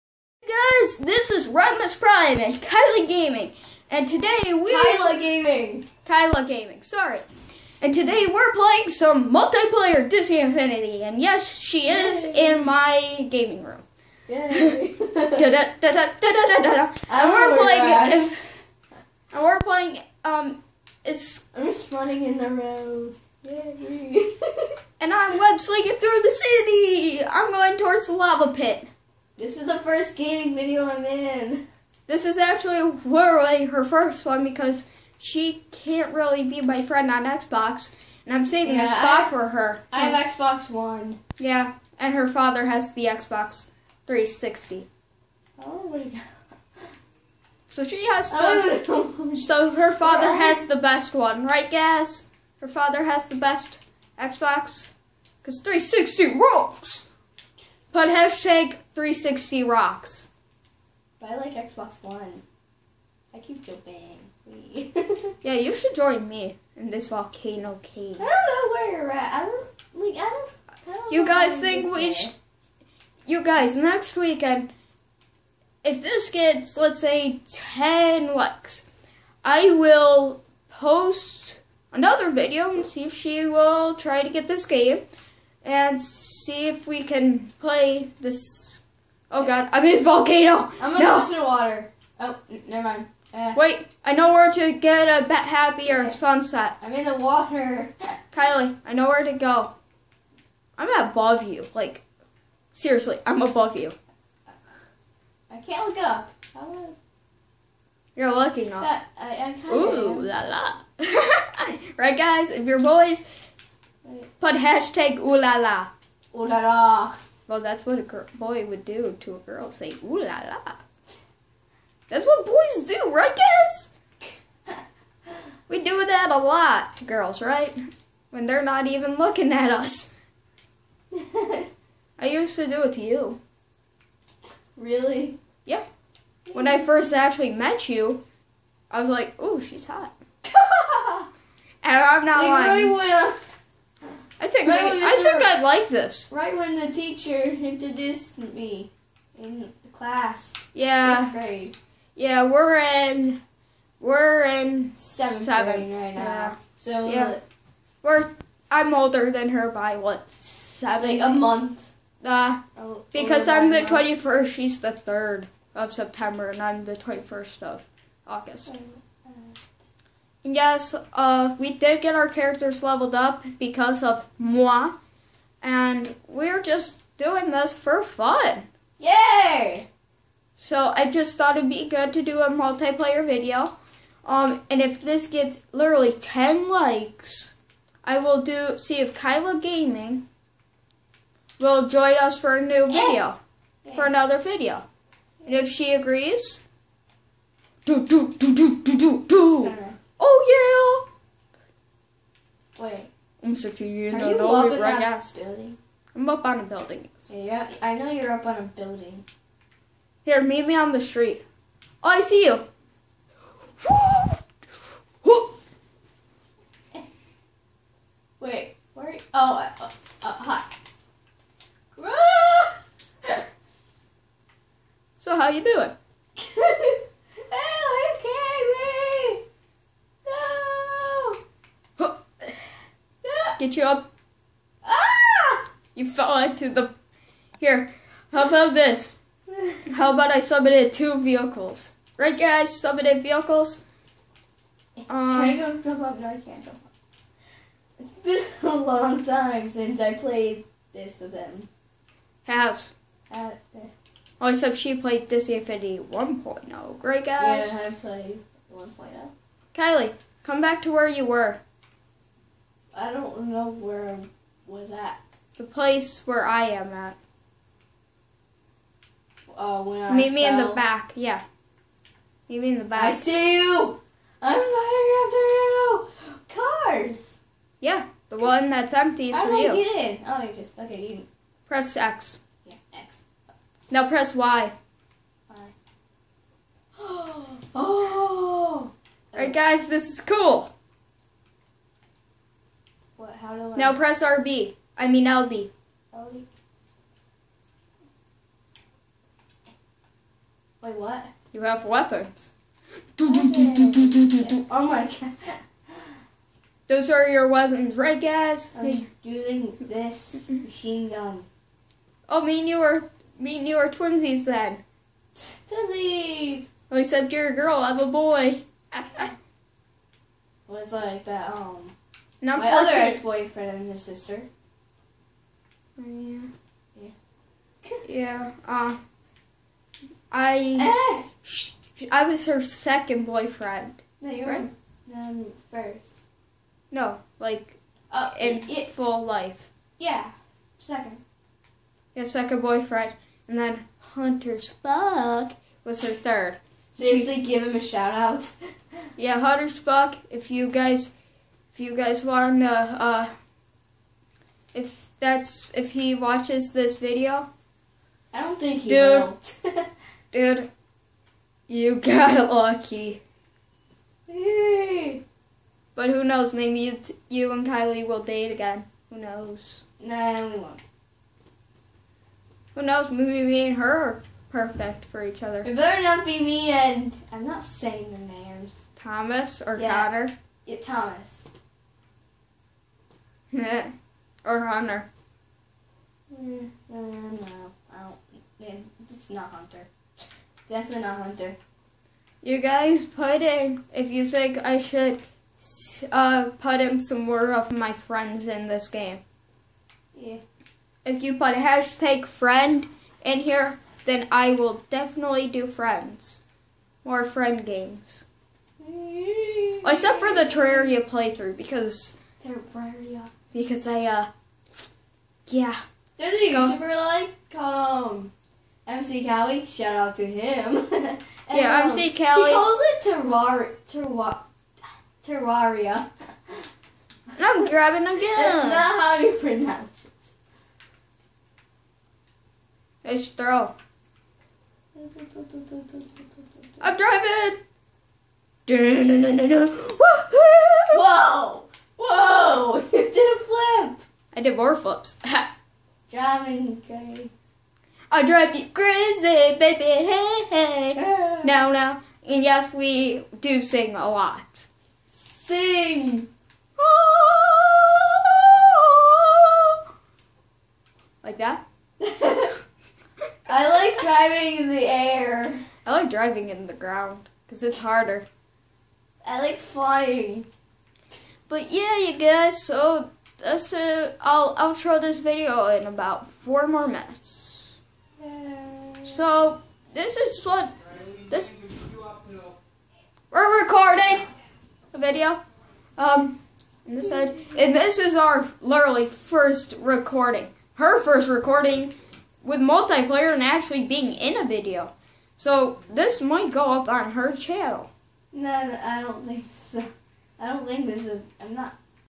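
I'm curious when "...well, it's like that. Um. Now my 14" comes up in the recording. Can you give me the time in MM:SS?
05:20.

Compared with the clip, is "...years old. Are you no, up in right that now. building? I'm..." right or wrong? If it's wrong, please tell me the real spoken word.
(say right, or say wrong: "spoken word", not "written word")
right.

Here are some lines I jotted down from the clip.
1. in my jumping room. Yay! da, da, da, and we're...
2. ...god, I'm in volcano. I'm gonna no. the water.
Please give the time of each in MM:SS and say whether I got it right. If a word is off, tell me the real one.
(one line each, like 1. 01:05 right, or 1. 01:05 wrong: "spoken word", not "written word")
1. 00:12 wrong: "gaming", not "jumping"
2. 01:29 right.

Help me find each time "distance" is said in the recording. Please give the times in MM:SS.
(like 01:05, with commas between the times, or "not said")
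not said.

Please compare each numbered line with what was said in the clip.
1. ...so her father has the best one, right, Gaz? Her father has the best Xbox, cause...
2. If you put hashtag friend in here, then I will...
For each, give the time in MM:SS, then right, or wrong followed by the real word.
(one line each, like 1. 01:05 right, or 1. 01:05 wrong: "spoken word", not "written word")
1. 00:49 right
2. 06:41 right.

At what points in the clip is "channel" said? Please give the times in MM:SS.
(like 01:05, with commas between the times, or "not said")
08:17.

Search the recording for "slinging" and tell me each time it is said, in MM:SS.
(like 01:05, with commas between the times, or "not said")
00:25.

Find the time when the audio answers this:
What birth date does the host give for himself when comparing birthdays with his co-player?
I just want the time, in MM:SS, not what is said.
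02:46.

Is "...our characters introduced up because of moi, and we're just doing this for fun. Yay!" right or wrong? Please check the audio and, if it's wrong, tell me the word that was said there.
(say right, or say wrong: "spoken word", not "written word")
wrong: "leveled", not "introduced".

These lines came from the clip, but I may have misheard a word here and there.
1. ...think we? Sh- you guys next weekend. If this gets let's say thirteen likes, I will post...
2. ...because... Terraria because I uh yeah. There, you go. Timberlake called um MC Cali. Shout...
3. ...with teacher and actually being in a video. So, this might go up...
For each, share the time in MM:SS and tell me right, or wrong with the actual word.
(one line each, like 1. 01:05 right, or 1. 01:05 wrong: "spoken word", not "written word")
1. 01:11 wrong: "ten", not "thirteen"
2. 06:51 right
3. 08:12 wrong: "multiplayer", not "teacher".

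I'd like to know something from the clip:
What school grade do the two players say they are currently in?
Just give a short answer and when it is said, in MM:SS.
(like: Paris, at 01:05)
Seventh grade, at 02:34.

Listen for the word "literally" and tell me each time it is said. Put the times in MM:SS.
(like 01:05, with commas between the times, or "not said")
00:33, 03:05, 08:08.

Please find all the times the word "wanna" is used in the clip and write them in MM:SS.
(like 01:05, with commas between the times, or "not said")
02:23, 05:52.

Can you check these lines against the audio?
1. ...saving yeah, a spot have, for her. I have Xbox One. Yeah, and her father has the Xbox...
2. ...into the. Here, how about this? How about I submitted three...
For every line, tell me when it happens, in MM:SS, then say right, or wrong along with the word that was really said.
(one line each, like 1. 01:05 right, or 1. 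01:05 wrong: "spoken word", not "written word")
1. 00:38 right
2. 03:56 wrong: "two", not "three".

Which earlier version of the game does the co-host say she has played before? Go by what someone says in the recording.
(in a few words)
Disney Infinity 1.0.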